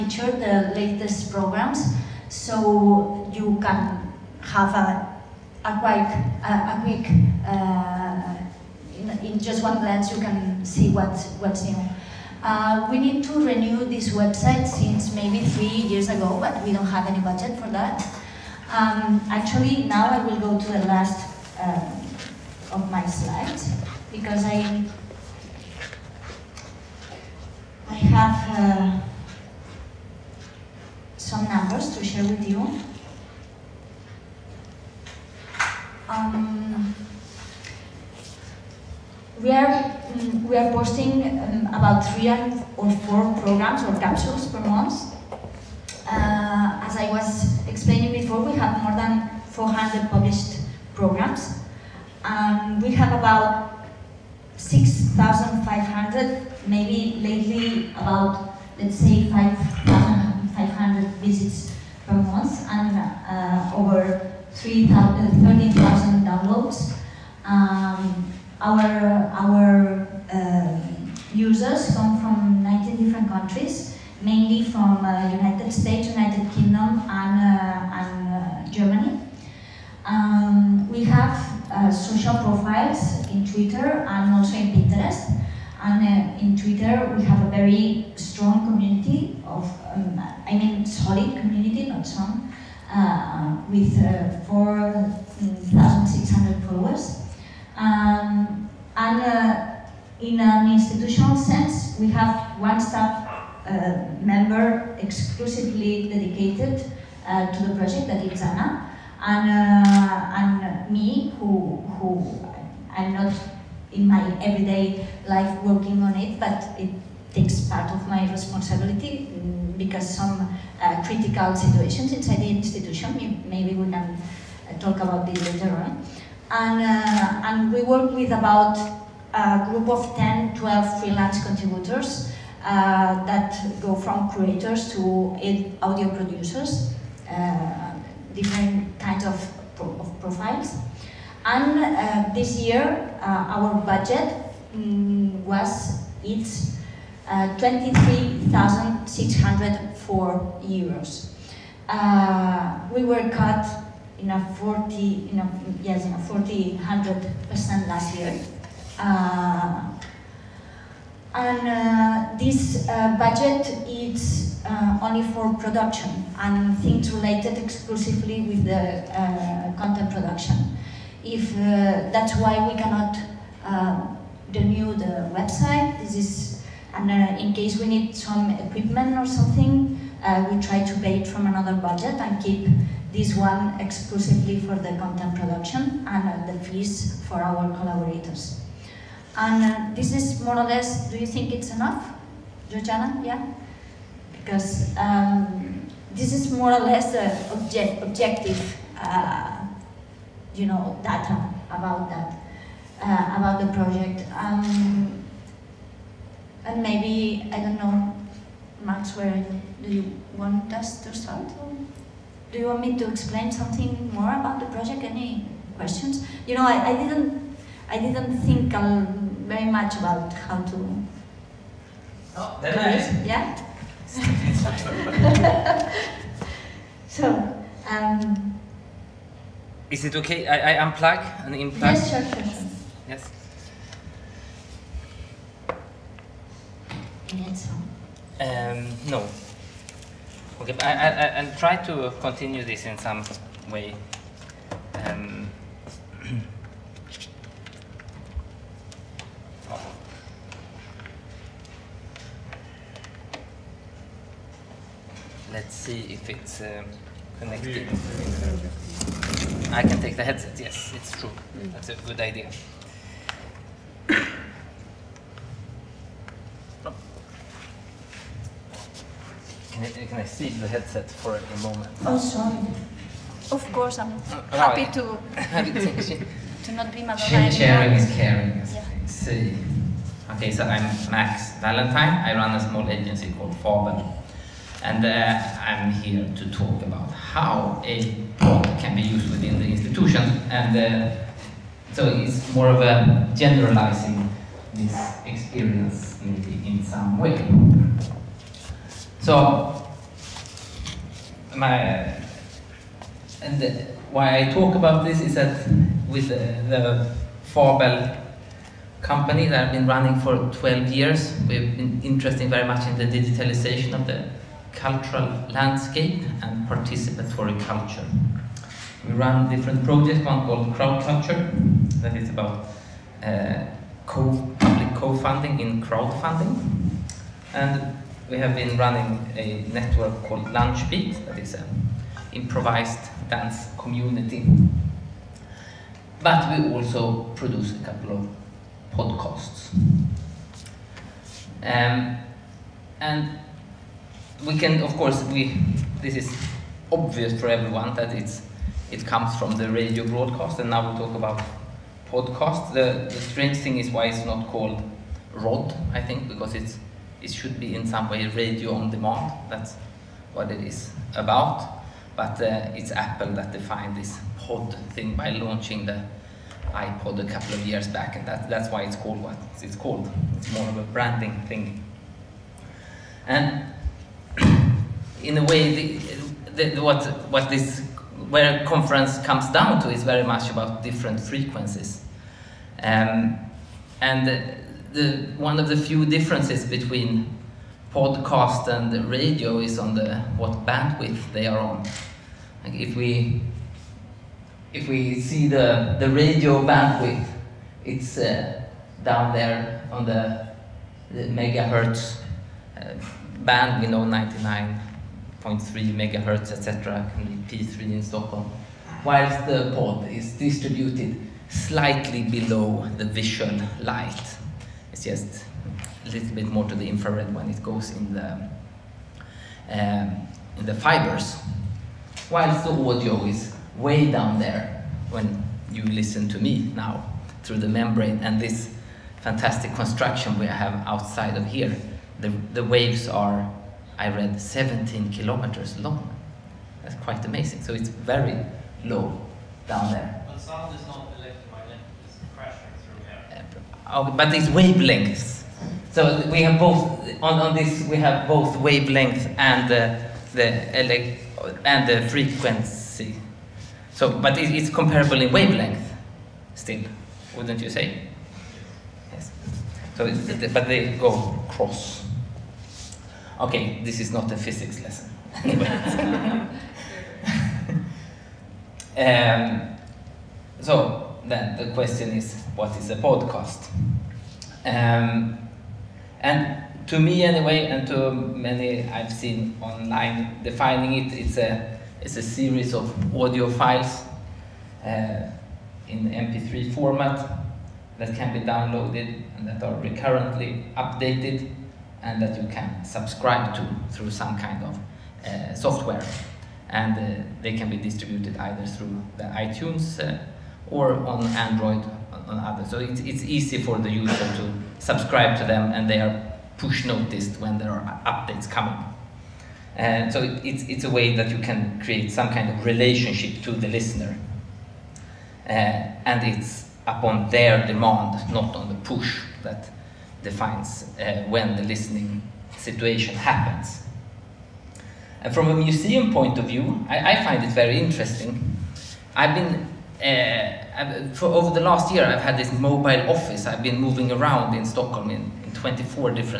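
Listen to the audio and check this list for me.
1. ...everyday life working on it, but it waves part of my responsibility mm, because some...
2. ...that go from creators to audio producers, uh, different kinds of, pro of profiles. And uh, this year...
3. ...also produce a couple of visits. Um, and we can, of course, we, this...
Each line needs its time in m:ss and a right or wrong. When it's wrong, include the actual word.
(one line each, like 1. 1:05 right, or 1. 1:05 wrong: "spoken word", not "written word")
1. 1:54 wrong: "takes", not "waves"
2. 2:13 right
3. 5:36 wrong: "podcasts", not "visits".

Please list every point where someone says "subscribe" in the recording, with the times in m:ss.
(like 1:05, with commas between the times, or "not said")
8:12, 8:24.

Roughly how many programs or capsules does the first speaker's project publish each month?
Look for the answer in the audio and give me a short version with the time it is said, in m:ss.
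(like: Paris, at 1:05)
3 or 4, at 0:42.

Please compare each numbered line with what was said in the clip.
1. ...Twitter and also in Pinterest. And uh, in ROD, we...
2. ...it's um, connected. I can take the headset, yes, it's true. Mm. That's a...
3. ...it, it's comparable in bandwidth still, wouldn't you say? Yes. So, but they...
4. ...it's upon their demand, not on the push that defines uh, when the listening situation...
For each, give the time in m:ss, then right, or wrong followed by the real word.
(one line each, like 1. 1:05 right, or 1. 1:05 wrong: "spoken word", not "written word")
1. 1:23 wrong: "Twitter", not "ROD"
2. 4:16 right
3. 7:34 wrong: "wavelength", not "bandwidth"
4. 8:36 right.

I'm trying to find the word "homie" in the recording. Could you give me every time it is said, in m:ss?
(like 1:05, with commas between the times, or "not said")
not said.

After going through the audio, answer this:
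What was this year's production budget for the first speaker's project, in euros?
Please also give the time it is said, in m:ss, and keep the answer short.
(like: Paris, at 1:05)
23,604 euros, at 2:27.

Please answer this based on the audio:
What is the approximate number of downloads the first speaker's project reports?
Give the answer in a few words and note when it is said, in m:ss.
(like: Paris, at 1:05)
over 30,000, at 1:04.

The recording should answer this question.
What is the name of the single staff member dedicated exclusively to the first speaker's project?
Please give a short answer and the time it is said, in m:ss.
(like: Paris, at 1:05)
Anna, at 1:48.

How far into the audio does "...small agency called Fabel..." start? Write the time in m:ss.
4:42.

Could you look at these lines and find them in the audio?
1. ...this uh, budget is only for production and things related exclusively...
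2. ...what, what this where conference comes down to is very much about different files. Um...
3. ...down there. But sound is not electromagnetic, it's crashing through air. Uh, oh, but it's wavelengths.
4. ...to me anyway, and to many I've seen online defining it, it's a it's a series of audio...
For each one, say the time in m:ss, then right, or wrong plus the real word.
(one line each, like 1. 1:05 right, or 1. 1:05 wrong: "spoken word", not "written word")
1. 2:42 right
2. 6:16 wrong: "frequencies", not "files"
3. 7:19 right
4. 7:56 right.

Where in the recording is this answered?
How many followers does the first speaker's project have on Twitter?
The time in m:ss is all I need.
1:34.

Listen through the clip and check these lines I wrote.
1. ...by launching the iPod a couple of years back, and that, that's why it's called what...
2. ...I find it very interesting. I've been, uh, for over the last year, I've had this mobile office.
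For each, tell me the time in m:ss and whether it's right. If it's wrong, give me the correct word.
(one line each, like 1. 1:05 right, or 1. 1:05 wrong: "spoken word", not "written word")
1. 6:05 right
2. 8:47 right.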